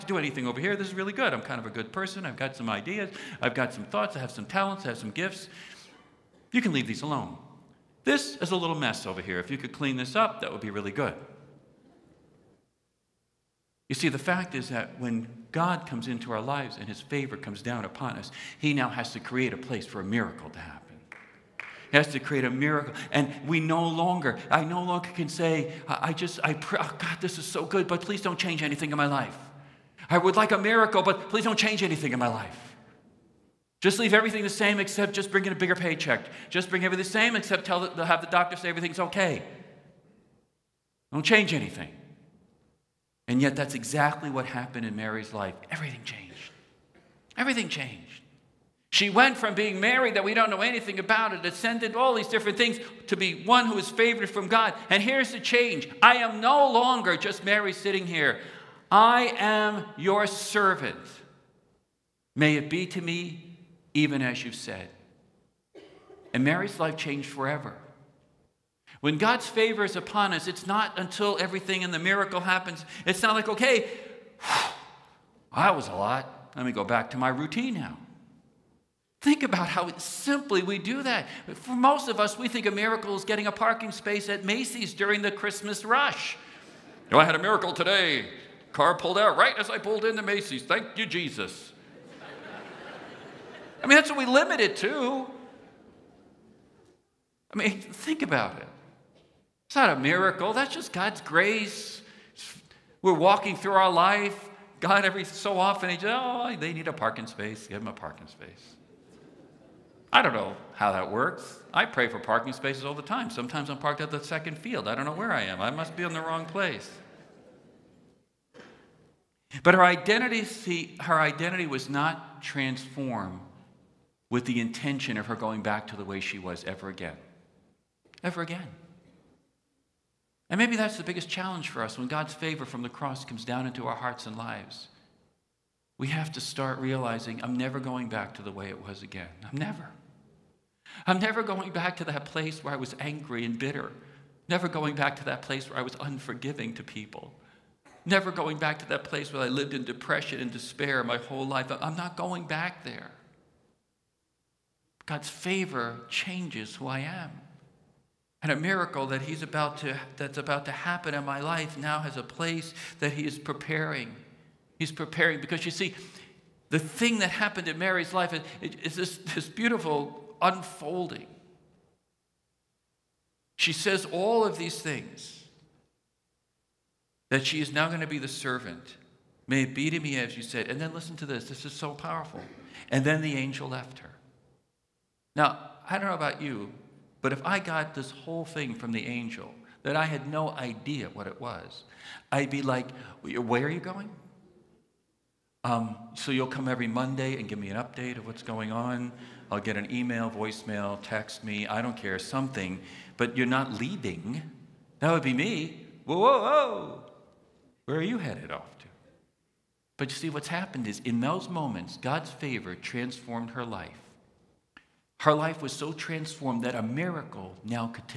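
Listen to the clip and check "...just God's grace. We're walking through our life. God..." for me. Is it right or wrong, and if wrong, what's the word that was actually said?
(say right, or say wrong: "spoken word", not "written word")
right.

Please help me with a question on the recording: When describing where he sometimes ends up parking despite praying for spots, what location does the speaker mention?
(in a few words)
the second field.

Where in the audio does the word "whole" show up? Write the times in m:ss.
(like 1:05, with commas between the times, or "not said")
2:31, 3:08.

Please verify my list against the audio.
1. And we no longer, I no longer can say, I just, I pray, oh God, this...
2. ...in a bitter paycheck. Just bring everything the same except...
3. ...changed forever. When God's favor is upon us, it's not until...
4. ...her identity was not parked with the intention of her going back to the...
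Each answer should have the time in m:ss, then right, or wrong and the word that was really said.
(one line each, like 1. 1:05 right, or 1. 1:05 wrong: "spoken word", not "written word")
1. 0:23 right
2. 0:35 wrong: "bigger", not "bitter"
3. 1:06 right
4. 2:00 wrong: "transformed", not "parked".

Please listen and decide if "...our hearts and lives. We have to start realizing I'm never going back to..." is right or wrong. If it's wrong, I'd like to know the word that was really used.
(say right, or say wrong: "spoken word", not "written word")
right.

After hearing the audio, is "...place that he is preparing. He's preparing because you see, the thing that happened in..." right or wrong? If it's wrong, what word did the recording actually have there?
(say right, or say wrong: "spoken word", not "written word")
right.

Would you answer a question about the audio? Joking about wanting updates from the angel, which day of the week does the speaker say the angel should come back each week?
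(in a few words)
Monday.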